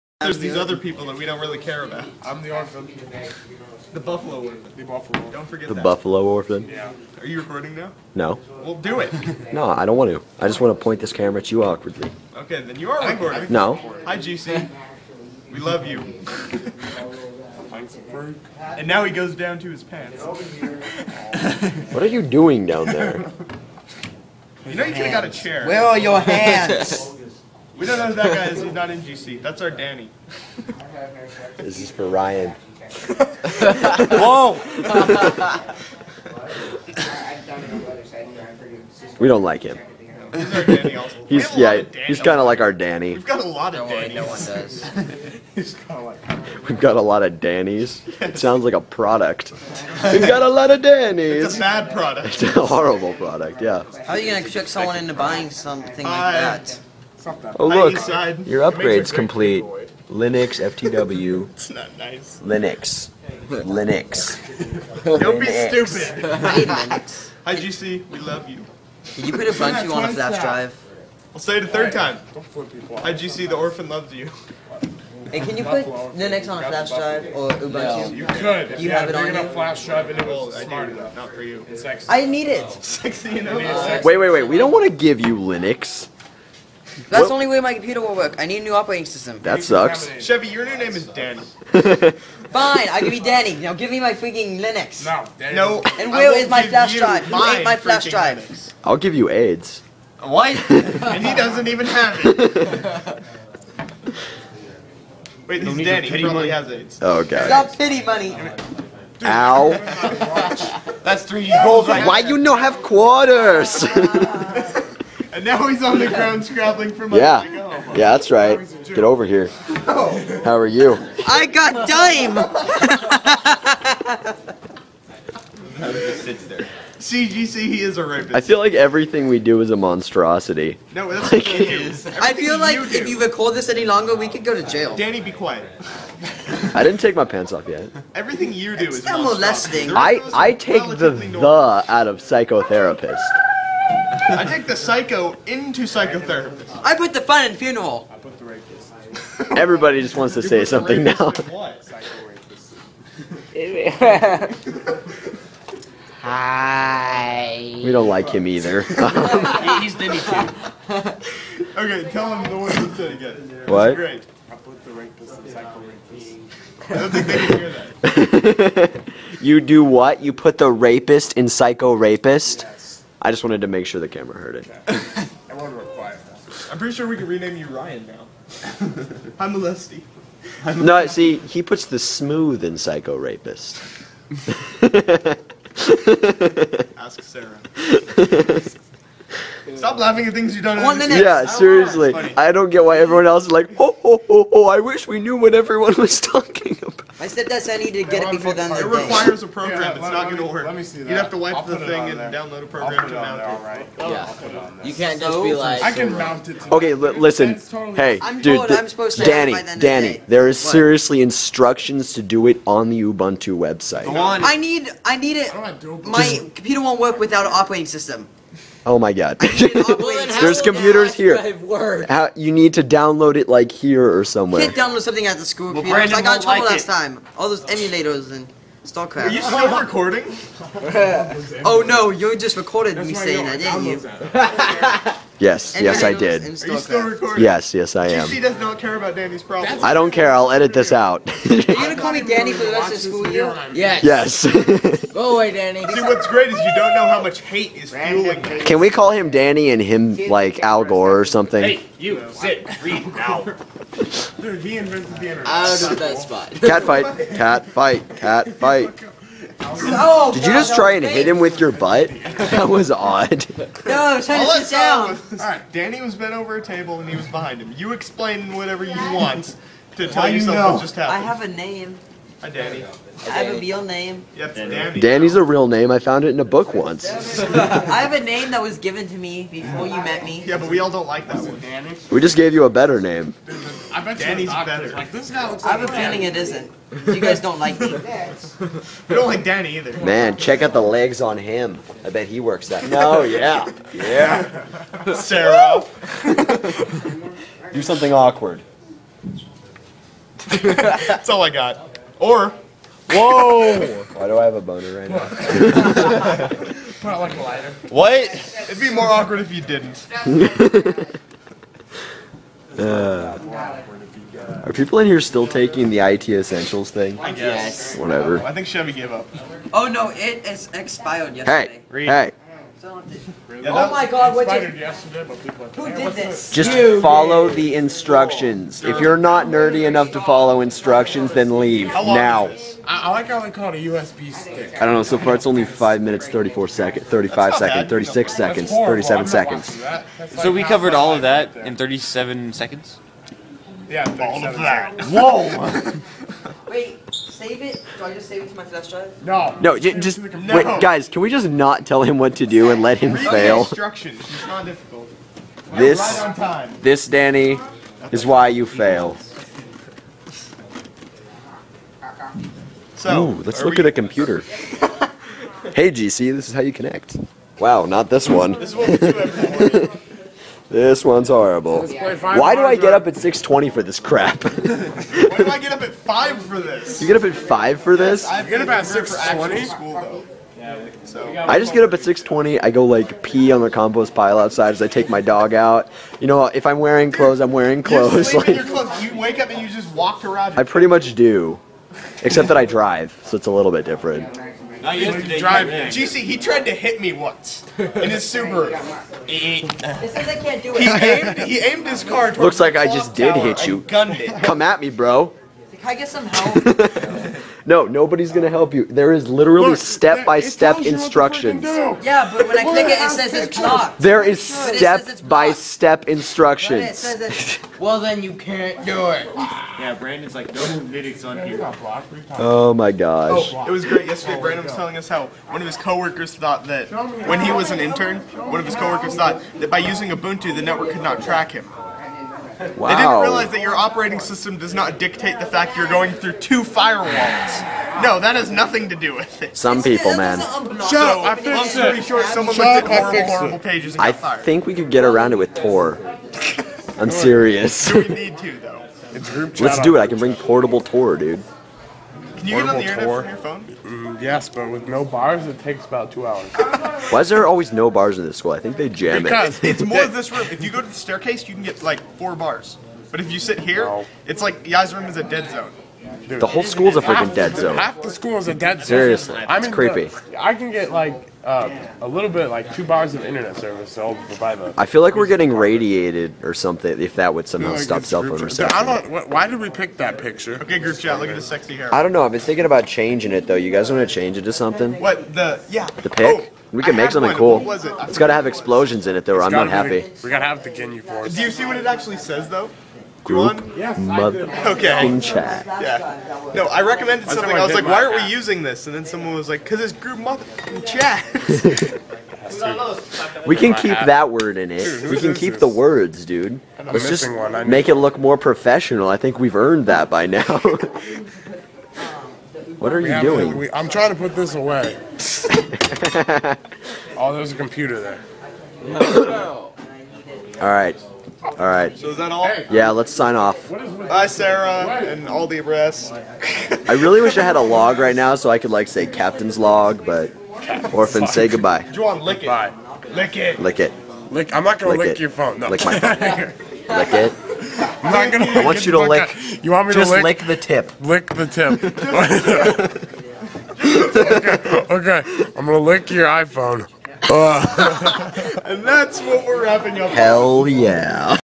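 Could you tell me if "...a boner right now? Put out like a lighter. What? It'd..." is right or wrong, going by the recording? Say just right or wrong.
right.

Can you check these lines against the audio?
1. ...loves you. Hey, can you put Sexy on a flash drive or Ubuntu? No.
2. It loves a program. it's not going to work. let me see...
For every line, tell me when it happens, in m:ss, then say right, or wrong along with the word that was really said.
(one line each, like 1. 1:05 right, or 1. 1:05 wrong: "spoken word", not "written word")
1. 1:13 wrong: "Linux", not "Sexy"
2. 3:18 wrong: "requires", not "loves".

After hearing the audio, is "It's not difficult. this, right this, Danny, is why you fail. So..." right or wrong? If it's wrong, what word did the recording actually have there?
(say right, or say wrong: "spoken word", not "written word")
right.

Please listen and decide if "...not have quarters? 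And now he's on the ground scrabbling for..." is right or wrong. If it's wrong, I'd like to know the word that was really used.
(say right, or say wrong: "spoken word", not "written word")
right.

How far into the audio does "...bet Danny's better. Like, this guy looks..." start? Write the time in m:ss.
4:44.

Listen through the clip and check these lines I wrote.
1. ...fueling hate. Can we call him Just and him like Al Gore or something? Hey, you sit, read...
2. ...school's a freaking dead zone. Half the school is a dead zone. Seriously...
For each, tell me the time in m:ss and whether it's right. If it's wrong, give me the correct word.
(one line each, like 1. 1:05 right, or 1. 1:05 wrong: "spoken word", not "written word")
1. 4:07 wrong: "Danny", not "Just"
2. 7:46 right.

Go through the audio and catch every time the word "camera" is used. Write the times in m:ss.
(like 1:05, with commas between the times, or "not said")
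0:11, 2:54.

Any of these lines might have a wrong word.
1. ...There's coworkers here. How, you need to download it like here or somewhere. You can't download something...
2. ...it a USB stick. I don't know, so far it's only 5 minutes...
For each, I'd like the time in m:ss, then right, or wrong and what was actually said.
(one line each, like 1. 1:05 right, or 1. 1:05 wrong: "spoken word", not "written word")
1. 3:39 wrong: "computers", not "coworkers"
2. 5:33 right.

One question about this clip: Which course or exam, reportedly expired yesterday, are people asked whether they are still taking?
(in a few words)
IT Essentials.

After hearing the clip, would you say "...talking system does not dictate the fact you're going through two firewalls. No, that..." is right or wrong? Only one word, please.
wrong.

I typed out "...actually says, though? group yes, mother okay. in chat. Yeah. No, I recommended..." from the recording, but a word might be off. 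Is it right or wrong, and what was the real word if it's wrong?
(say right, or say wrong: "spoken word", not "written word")
right.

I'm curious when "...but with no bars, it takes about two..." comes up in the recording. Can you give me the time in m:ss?
7:34.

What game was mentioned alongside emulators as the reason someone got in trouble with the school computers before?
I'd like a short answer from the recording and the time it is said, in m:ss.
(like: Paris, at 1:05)
StarCraft, at 3:48.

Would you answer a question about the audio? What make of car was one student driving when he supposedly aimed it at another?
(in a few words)
Subaru.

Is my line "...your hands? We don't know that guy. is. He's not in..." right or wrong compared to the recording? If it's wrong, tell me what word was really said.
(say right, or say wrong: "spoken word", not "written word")
right.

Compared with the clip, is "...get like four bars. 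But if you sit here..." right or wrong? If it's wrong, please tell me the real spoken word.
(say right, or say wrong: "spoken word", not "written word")
right.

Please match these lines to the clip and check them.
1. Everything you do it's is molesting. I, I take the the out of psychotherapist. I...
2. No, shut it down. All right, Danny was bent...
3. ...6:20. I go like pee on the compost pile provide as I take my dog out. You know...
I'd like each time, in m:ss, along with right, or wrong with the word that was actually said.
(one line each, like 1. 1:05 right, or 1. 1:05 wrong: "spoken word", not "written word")
1. 2:18 right
2. 4:23 right
3. 6:21 wrong: "outside", not "provide".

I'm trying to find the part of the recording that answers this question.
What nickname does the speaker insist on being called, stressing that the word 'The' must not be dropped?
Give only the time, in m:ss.
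0:03.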